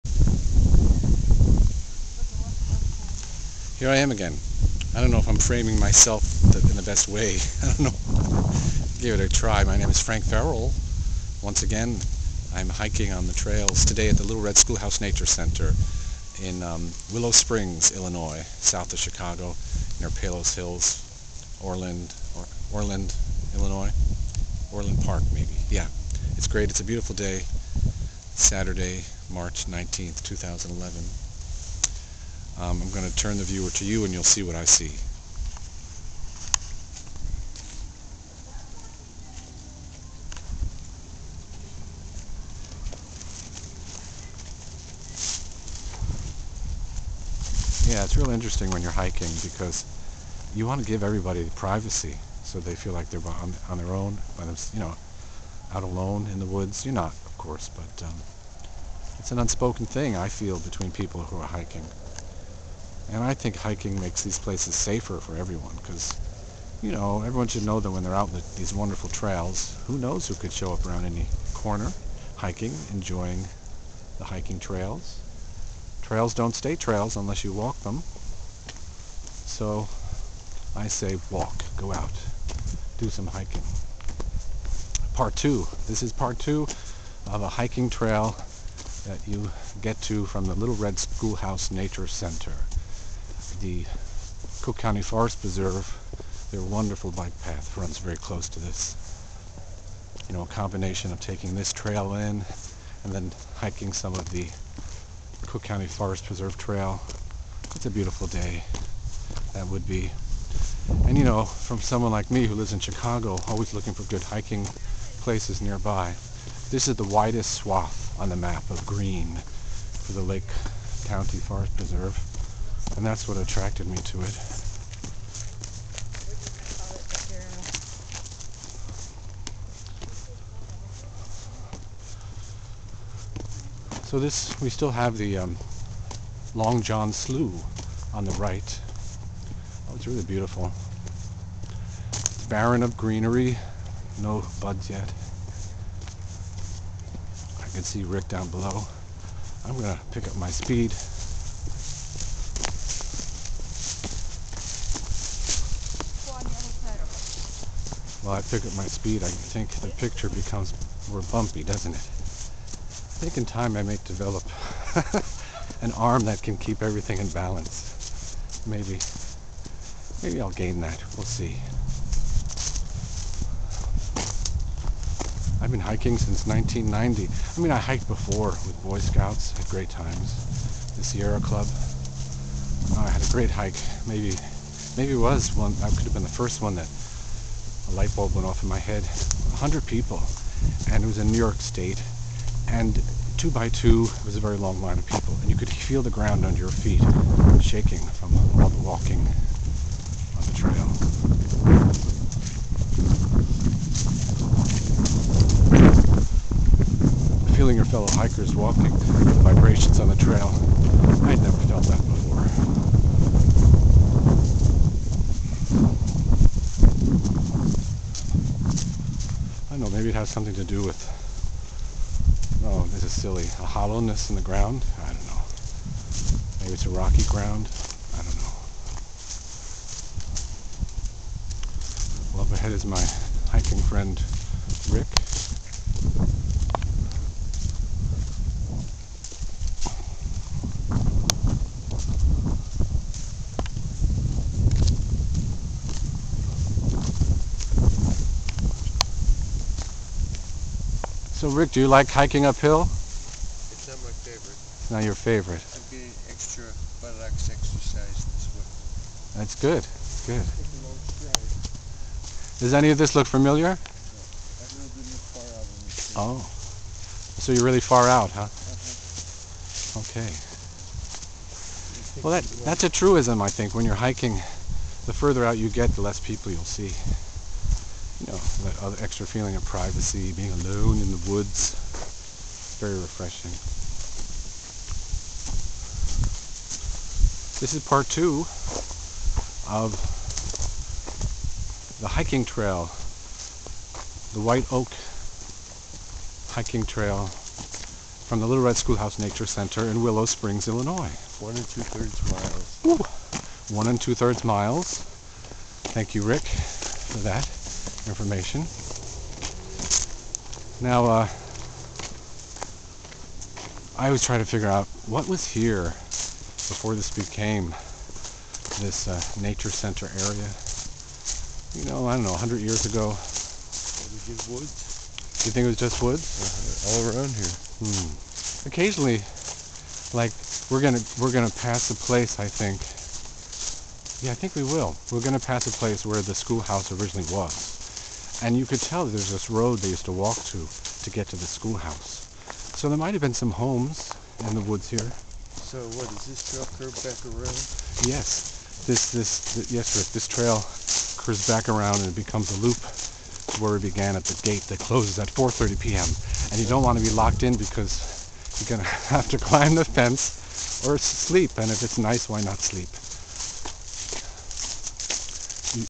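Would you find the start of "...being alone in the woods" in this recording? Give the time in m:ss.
4:40.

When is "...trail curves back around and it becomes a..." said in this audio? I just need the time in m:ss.
5:50.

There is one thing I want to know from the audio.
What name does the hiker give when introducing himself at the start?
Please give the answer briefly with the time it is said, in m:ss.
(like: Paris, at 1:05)
Frank Farrell, at 0:09.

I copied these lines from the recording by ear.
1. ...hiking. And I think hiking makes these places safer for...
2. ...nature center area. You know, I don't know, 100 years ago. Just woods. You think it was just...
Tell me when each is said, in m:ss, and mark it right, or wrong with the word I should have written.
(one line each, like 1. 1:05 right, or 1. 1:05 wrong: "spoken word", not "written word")
1. 1:01 right
2. 5:19 right.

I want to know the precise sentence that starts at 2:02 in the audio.
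And that's what attracted me to it.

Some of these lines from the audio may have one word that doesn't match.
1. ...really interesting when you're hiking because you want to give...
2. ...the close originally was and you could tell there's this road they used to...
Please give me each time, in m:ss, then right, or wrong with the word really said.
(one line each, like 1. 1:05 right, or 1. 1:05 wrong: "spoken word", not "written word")
1. 0:48 right
2. 5:36 wrong: "schoolhouse", not "close".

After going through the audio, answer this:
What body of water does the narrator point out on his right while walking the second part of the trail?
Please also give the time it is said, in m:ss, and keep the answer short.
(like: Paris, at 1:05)
Long John Slough, at 2:16.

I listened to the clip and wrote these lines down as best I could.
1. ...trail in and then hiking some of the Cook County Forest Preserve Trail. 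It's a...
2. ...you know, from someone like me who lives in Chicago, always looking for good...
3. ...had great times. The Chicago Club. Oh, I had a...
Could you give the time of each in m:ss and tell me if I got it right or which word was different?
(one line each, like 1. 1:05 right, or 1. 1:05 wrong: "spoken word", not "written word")
1. 1:41 right
2. 1:51 right
3. 2:59 wrong: "Sierra", not "Chicago".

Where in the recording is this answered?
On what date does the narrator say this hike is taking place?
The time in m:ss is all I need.
0:28.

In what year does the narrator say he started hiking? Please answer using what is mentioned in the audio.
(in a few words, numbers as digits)
1990.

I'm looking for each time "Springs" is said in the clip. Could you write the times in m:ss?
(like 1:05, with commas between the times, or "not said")
0:17, 5:00.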